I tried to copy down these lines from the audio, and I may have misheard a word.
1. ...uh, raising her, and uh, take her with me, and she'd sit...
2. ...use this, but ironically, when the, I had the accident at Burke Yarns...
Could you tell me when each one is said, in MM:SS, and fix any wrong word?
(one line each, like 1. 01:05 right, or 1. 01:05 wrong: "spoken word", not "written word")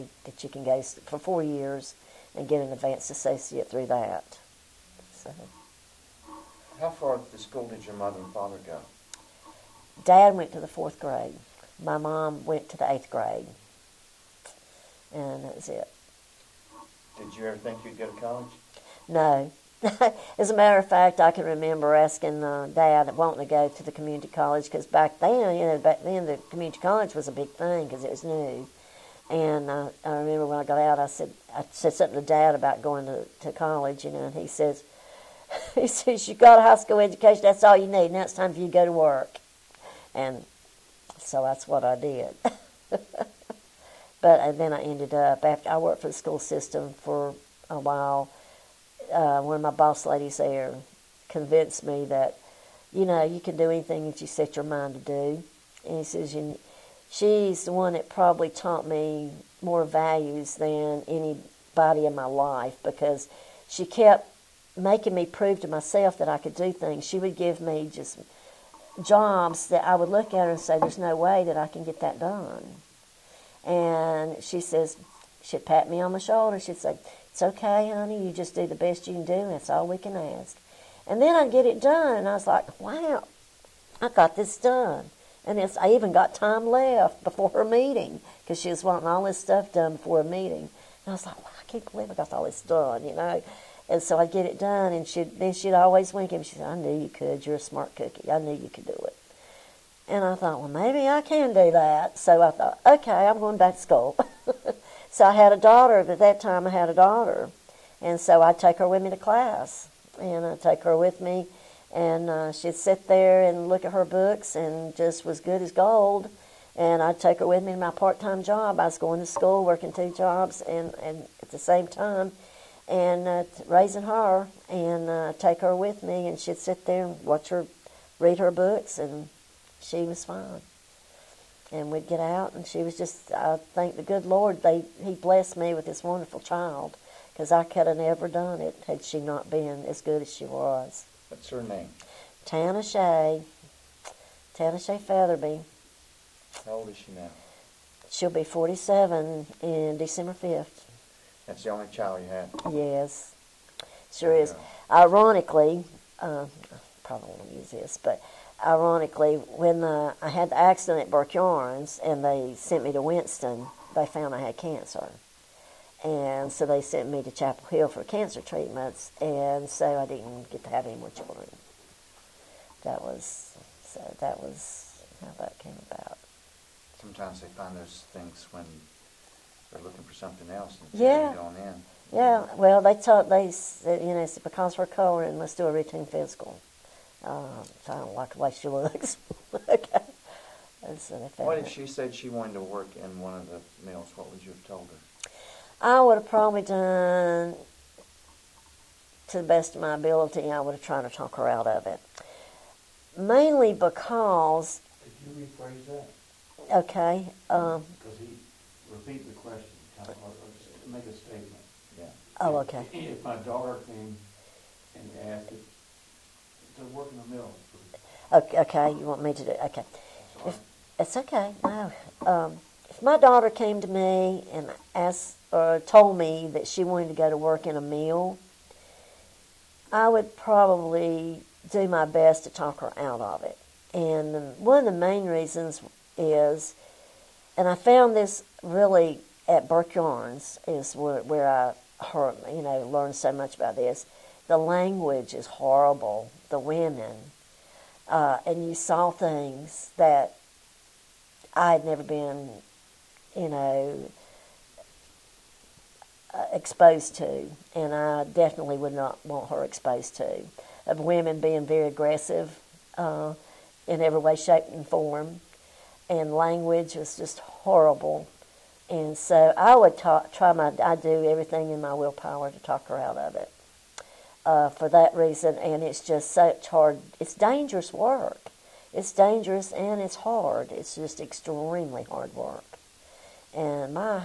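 1. 02:03 right
2. 02:37 right.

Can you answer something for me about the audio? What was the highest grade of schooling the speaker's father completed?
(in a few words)
4th grade.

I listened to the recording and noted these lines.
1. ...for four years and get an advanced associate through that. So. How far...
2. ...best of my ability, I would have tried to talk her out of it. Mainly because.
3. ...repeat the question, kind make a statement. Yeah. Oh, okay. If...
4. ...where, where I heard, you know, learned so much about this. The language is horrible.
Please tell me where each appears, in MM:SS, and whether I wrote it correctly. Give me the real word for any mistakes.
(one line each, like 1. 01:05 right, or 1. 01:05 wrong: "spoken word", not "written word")
1. 00:00 right
2. 03:19 right
3. 03:28 right
4. 04:00 right.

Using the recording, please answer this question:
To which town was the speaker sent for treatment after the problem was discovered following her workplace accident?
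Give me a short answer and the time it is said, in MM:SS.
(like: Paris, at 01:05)
Chapel Hill, at 02:47.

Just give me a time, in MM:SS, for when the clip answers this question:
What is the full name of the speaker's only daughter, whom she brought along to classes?
02:24.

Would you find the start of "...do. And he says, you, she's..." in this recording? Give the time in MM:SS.
00:54.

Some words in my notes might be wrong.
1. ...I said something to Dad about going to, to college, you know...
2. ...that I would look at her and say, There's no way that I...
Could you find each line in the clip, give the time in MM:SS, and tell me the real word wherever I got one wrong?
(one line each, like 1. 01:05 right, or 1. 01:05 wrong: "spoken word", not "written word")
1. 00:31 right
2. 01:09 right.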